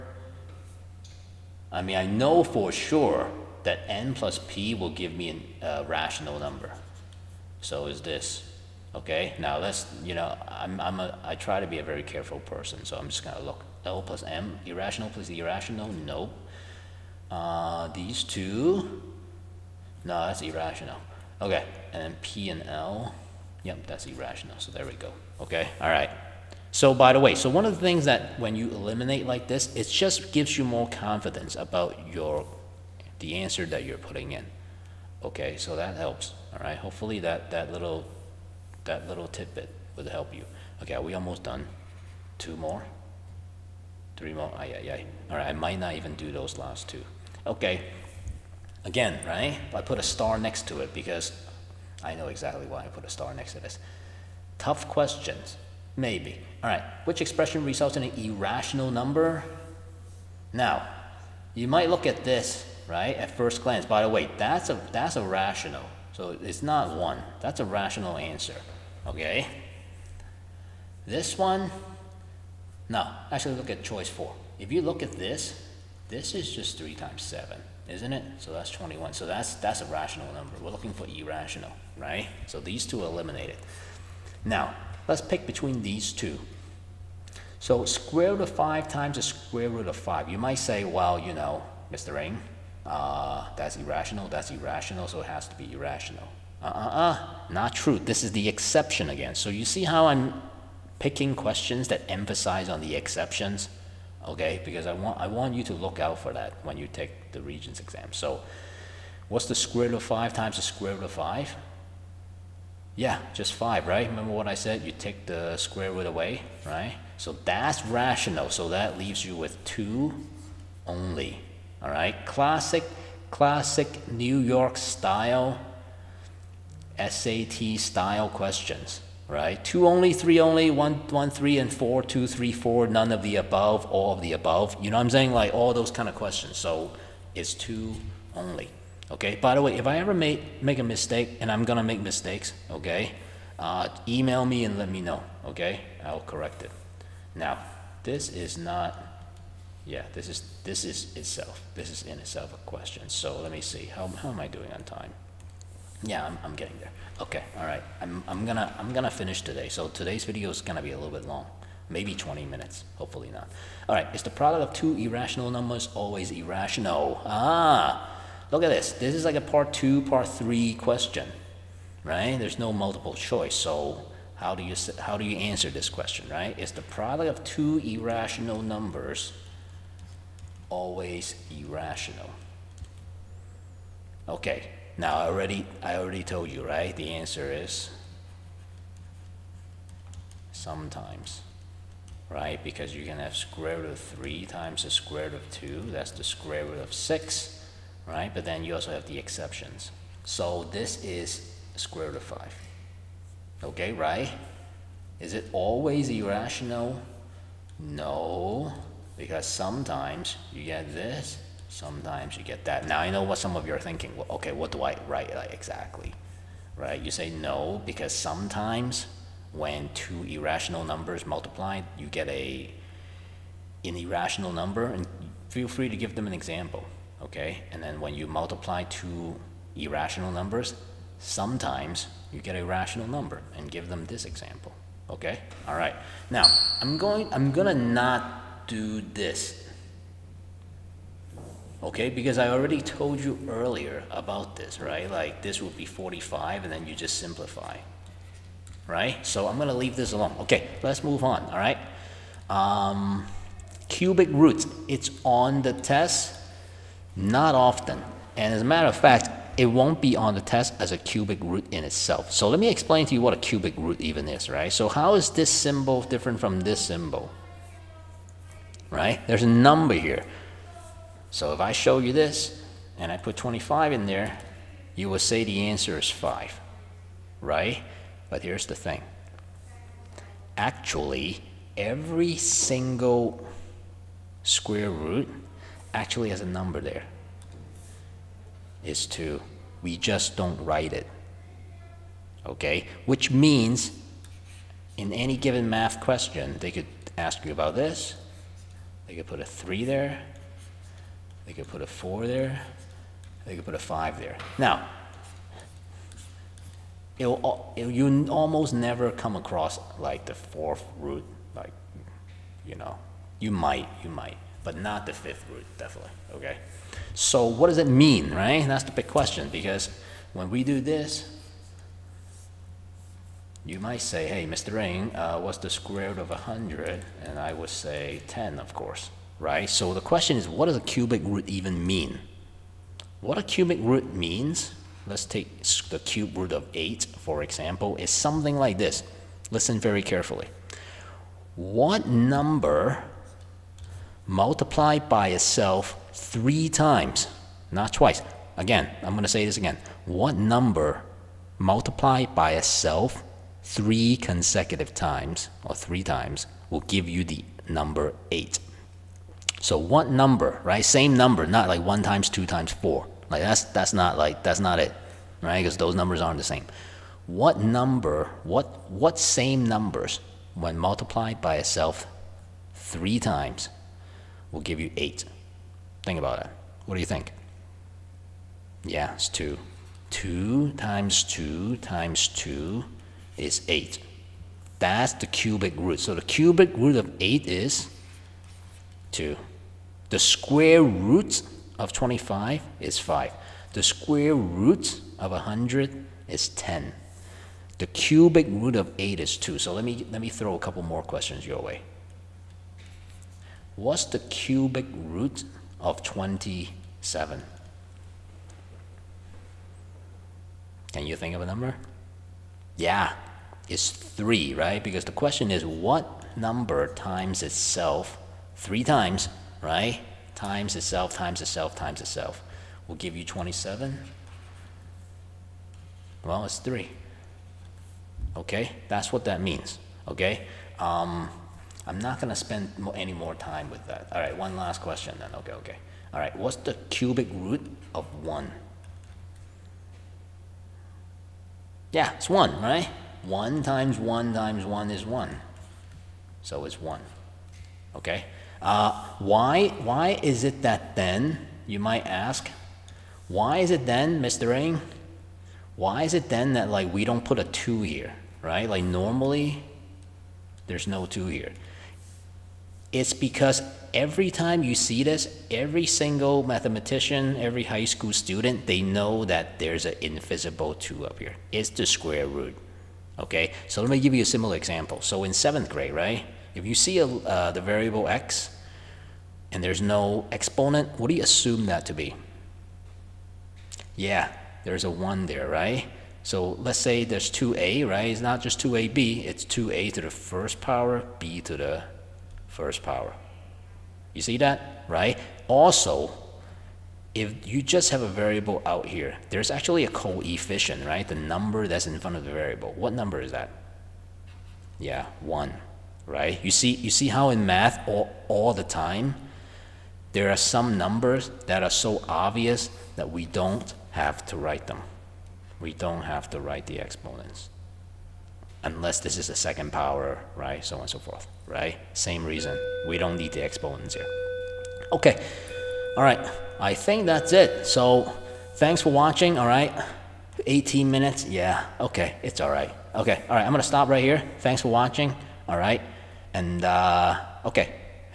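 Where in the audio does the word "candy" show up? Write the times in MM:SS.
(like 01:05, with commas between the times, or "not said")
not said.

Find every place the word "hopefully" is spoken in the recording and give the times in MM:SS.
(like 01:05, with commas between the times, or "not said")
00:36, 02:42.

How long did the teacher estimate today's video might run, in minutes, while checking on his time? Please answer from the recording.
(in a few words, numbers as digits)
20 minutes.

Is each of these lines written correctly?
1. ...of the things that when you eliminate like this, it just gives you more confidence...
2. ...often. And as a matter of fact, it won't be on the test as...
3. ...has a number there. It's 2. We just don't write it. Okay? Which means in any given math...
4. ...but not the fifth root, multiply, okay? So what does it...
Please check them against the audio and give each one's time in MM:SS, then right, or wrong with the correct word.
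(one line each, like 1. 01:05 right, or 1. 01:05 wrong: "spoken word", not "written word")
1. 00:27 right
2. 04:17 right
3. 04:46 right
4. 05:14 wrong: "definitely", not "multiply".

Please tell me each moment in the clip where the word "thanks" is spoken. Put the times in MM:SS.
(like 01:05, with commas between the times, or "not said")
08:48, 08:54.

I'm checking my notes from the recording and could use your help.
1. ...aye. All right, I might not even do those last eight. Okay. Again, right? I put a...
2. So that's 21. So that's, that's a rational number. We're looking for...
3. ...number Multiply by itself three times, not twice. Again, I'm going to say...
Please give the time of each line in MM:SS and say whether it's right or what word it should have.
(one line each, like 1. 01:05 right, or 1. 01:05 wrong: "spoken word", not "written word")
1. 00:44 wrong: "two", not "eight"
2. 01:18 right
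3. 05:42 right.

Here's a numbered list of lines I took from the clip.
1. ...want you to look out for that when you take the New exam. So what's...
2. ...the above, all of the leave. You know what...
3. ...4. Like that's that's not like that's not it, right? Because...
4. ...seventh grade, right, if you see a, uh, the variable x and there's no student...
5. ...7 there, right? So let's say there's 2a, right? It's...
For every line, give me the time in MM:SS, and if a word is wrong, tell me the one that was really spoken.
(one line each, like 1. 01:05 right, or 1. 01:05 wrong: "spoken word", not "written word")
1. 01:45 wrong: "Regents", not "New"
2. 02:13 wrong: "above", not "leave"
3. 06:02 right
4. 07:55 wrong: "exponent", not "student"
5. 08:04 wrong: "1", not "7".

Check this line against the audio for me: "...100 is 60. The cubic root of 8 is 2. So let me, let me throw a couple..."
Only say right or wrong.
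wrong.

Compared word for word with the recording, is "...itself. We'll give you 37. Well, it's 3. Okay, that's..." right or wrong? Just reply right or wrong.
wrong.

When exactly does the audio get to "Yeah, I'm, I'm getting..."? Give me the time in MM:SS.
02:36.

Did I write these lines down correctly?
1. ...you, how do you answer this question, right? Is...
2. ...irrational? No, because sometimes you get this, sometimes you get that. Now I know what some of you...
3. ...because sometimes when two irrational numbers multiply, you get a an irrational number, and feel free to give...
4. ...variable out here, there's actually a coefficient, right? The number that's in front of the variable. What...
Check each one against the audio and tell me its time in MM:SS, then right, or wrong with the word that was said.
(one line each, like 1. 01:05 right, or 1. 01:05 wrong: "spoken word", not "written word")
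1. 02:54 right
2. 03:26 right
3. 03:37 right
4. 08:18 right.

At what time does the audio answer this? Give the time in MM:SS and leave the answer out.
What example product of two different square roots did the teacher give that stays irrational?
03:15.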